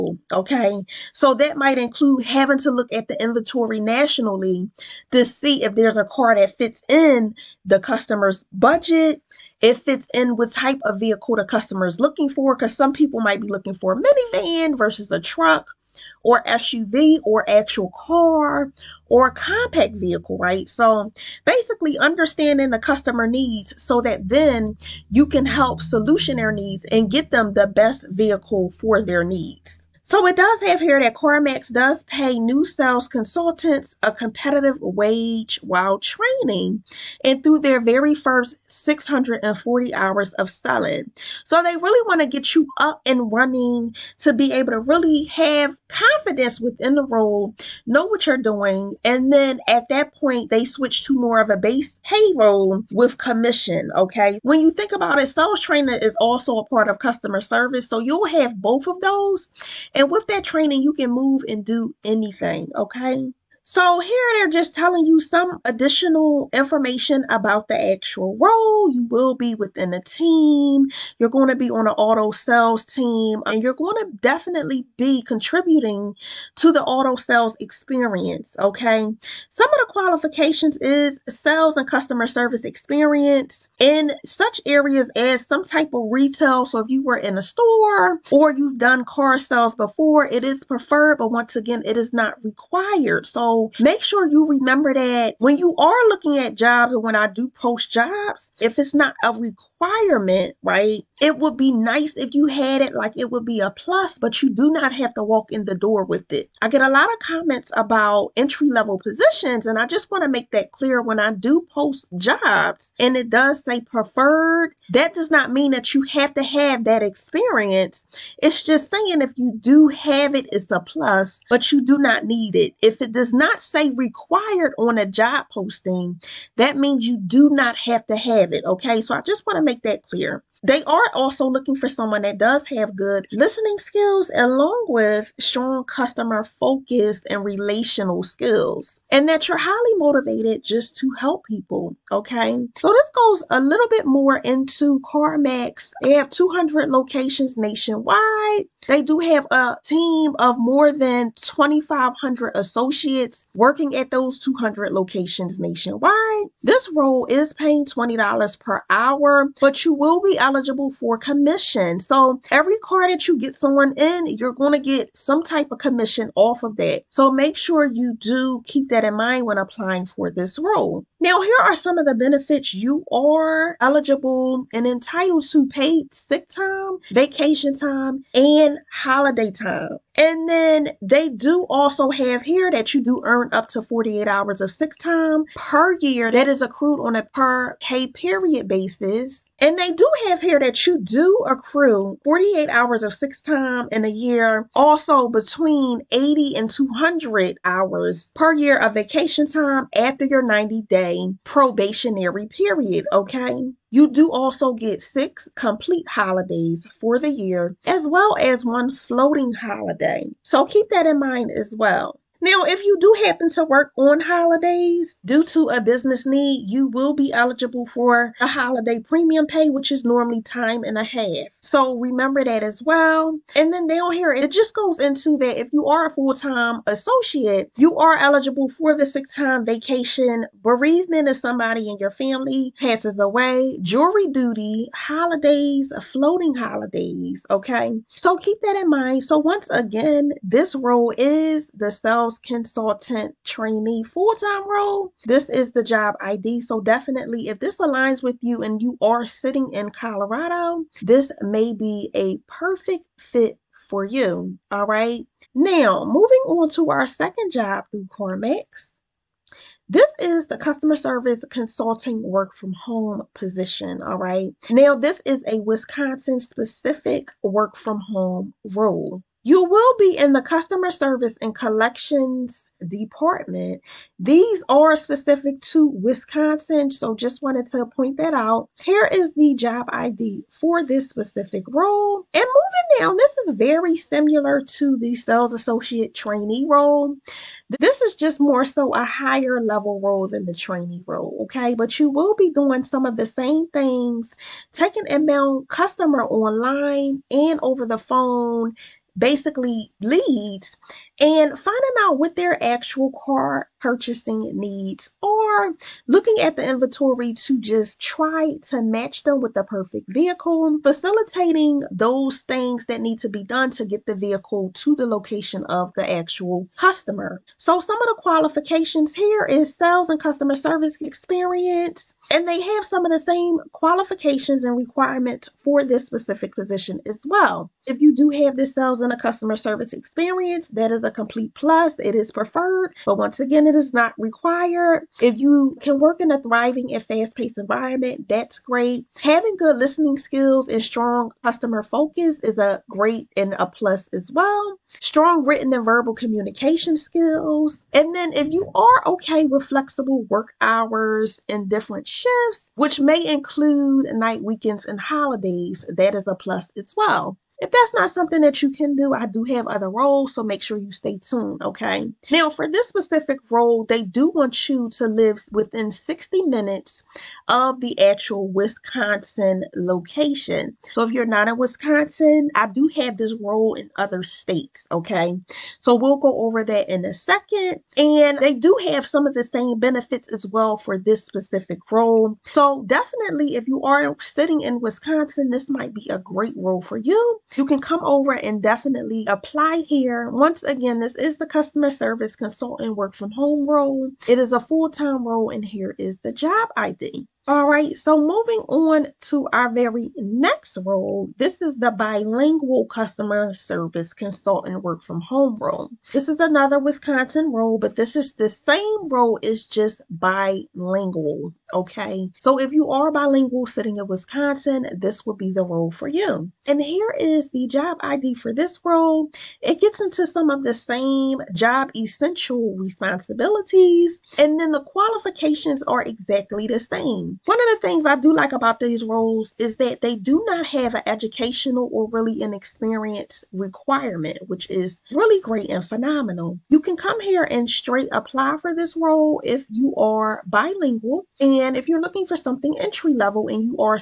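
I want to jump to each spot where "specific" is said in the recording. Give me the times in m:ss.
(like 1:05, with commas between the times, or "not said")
4:26, 4:34, 4:41, 5:26, 6:02, 6:21.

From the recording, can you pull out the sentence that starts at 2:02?
If it does not not say required on a job posting, that means you do not have to have it.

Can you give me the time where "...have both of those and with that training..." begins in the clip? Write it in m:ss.
0:58.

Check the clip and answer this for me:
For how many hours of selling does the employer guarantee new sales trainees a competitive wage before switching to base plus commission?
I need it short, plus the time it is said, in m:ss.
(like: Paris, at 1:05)
640 hours, at 0:38.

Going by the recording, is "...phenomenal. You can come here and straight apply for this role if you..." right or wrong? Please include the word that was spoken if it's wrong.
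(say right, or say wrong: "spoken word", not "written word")
right.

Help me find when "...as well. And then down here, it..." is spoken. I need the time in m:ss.
3:42.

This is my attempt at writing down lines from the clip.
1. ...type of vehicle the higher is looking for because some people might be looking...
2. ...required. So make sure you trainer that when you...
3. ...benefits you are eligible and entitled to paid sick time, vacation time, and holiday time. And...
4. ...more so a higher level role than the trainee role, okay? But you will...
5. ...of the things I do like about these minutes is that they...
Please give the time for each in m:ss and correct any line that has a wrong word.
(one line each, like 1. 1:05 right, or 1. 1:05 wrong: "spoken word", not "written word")
1. 0:10 wrong: "customer", not "higher"
2. 1:32 wrong: "remember", not "trainer"
3. 2:52 right
4. 4:48 right
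5. 7:07 wrong: "roles", not "minutes".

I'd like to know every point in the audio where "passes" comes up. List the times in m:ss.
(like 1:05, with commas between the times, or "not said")
3:52.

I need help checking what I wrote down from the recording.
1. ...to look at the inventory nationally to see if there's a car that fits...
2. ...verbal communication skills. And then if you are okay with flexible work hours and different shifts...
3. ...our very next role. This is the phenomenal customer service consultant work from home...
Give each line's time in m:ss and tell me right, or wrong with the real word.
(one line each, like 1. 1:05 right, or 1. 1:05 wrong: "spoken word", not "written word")
1. 0:02 right
2. 5:45 right
3. 6:39 wrong: "bilingual", not "phenomenal".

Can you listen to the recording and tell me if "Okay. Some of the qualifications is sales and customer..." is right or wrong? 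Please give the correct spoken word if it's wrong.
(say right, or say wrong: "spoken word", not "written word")
right.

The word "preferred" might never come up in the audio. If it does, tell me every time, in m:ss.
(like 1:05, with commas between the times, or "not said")
1:30, 1:53, 5:32.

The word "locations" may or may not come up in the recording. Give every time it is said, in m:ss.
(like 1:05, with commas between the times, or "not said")
2:26, 2:34, 5:15, 6:09.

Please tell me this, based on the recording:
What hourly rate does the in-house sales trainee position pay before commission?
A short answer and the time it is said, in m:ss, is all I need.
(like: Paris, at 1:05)
$20 per hour, at 2:37.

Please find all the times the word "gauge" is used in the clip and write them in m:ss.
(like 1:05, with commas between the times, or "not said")
not said.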